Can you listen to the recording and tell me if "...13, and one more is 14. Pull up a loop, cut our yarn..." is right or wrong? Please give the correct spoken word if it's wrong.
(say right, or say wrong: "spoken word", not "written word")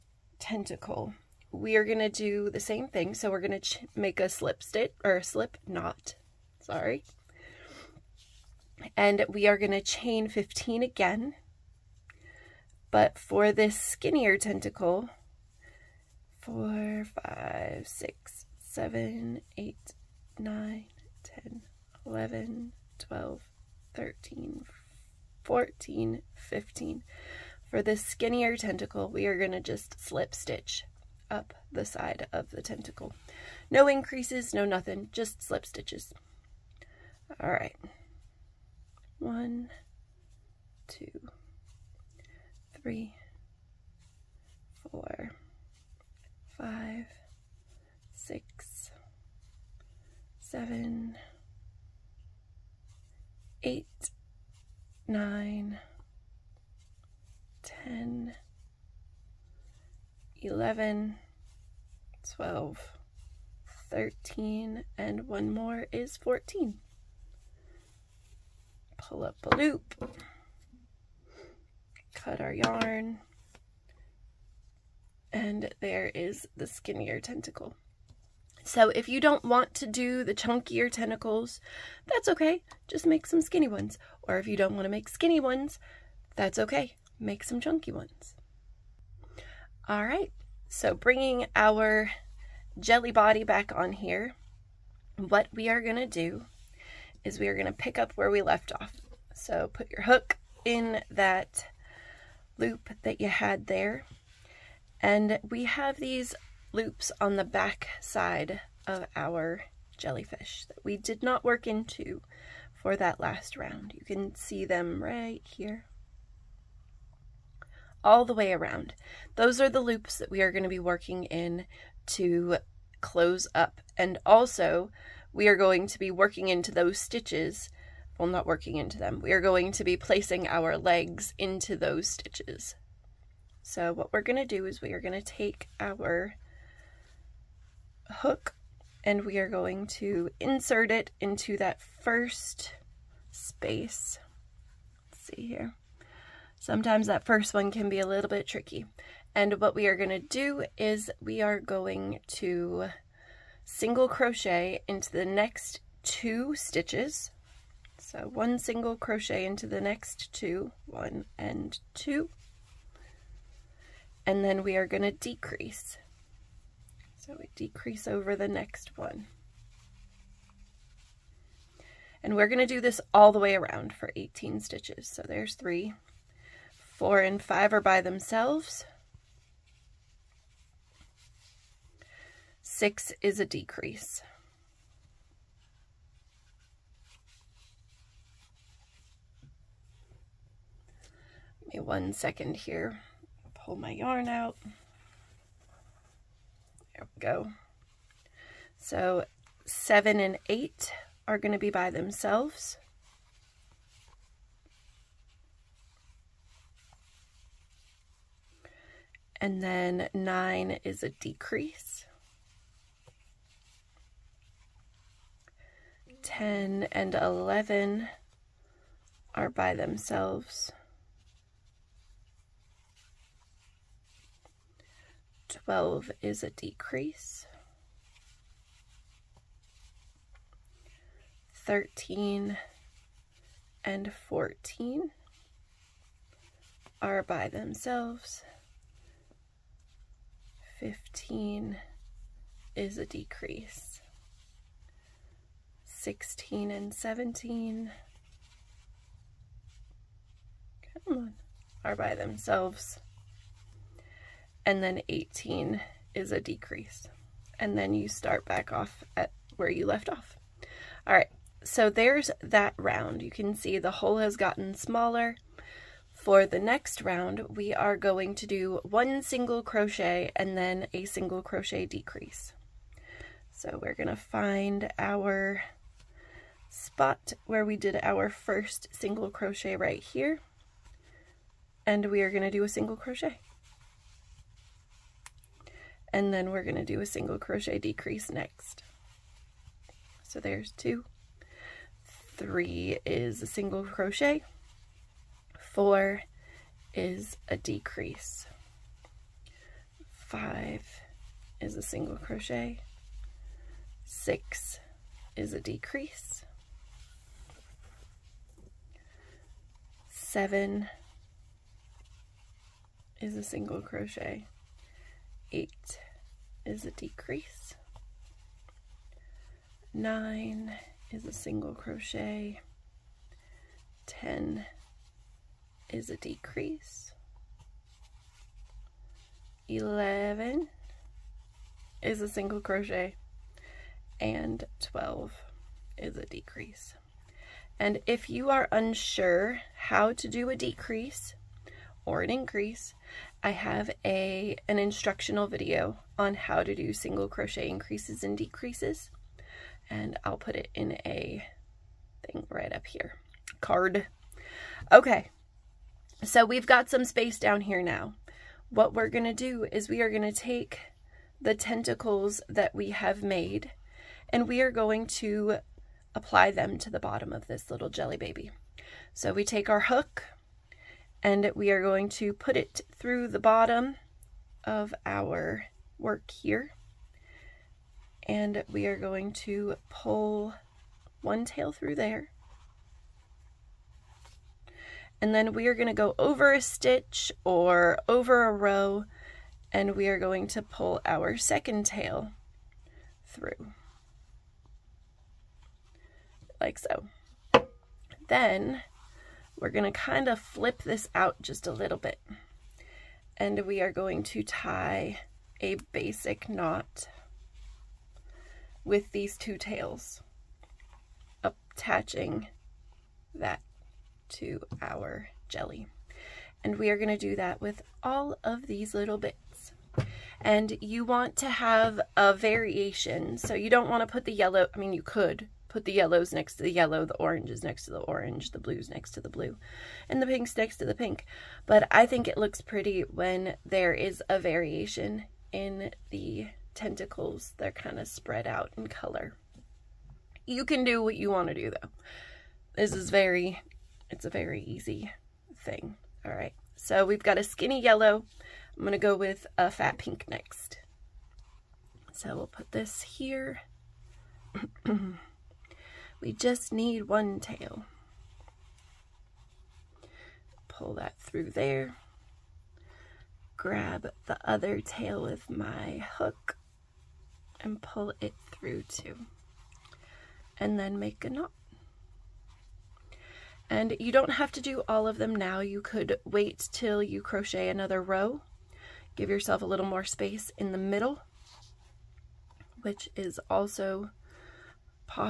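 right.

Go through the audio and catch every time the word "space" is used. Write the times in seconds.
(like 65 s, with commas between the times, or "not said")
143 s, 357 s, 480 s.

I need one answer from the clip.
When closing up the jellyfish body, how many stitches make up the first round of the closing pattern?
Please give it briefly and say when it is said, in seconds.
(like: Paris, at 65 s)
18, at 174 s.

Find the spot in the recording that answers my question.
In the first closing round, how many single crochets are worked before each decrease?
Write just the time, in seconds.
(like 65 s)
153 s.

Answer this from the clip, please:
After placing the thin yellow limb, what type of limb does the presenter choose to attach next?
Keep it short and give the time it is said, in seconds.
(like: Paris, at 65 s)
fat pink, at 449 s.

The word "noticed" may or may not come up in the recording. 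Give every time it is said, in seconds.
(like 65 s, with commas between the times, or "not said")
not said.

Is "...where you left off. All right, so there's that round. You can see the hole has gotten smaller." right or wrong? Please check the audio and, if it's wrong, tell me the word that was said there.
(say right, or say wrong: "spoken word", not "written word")
right.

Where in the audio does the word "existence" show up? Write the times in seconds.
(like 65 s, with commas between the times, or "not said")
not said.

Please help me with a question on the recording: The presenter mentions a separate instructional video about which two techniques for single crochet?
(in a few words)
increases and decreases.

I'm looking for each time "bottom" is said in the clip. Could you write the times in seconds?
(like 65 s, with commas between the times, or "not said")
366 s, 373 s.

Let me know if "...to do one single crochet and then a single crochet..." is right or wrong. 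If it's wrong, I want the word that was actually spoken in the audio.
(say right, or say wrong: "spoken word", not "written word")
right.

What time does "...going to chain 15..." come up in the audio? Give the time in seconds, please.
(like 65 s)
9 s.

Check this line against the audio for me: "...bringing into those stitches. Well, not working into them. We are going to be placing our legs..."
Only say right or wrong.
wrong.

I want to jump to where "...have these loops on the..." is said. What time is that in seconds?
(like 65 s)
105 s.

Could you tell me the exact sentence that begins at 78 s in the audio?
So if you don't want to do the chunkier tentacles, that's okay.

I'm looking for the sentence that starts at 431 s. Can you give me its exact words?
But I think it looks pretty when there is a variation in the tentacles.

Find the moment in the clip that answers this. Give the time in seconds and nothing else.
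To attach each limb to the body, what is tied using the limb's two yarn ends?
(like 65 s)
405 s.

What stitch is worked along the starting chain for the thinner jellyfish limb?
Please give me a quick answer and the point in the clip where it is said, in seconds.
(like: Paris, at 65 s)
slip stitches, at 35 s.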